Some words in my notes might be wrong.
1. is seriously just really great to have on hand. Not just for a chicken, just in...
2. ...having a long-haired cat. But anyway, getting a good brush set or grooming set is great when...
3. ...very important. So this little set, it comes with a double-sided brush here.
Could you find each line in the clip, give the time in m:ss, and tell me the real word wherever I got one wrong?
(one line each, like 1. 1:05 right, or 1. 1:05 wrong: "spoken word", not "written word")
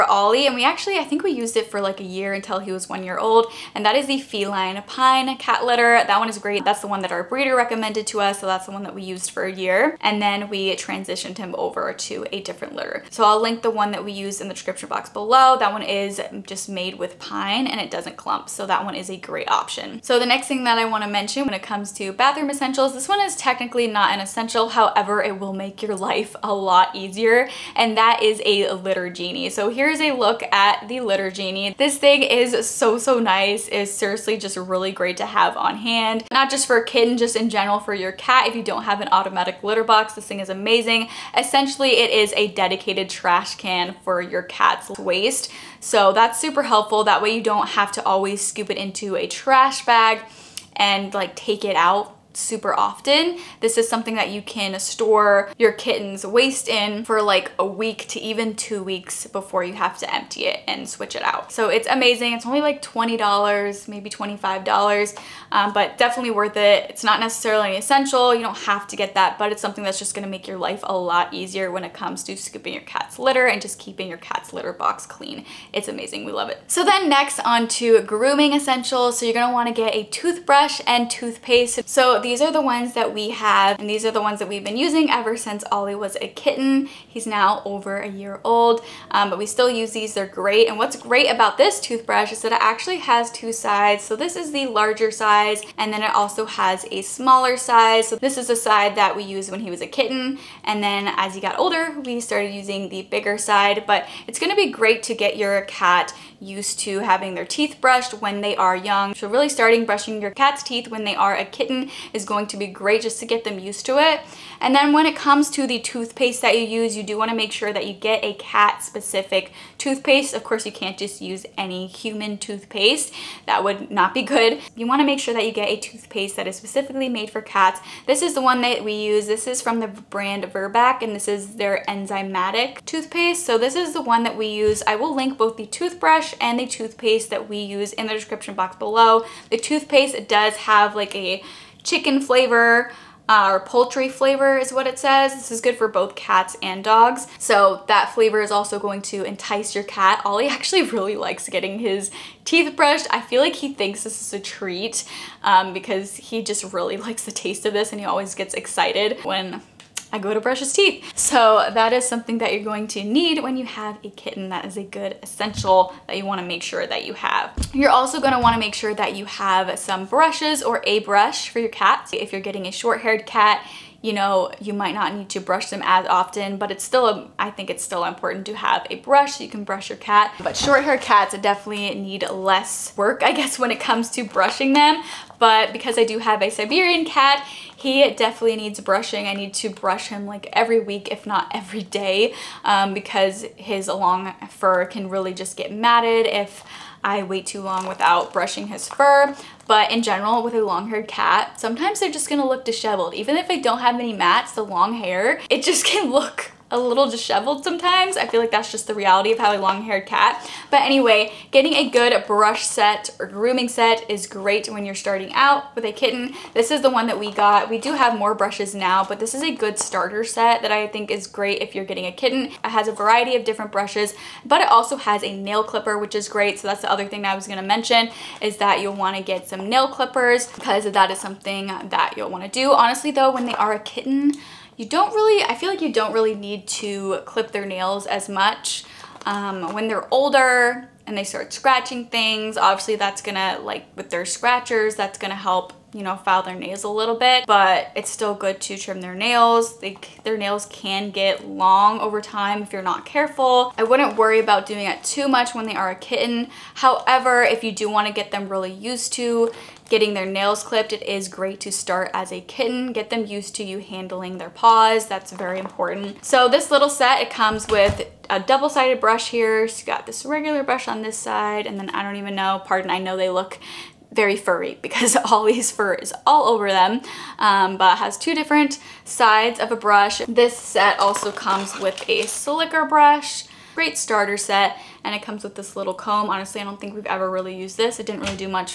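1. 0:33 wrong: "kitten", not "chicken"
2. 3:29 right
3. 4:25 right.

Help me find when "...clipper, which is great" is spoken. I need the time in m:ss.
3:45.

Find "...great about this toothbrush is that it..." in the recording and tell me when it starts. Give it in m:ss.
1:30.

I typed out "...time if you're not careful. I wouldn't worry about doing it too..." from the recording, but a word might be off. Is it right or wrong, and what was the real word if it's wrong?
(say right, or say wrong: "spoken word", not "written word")
right.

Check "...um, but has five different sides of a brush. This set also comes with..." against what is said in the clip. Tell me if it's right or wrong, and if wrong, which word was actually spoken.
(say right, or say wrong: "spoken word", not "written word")
wrong: "two", not "five".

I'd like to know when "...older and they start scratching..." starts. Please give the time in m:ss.
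4:00.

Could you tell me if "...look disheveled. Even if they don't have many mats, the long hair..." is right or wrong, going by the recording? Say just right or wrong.
right.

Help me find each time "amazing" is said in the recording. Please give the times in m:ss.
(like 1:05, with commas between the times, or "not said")
0:40, 1:01, 1:15.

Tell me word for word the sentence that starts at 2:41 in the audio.
So that is something that you're going to need when you have a kitten.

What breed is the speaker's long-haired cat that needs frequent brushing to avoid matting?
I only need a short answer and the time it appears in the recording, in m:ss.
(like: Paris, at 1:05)
Siberian, at 3:06.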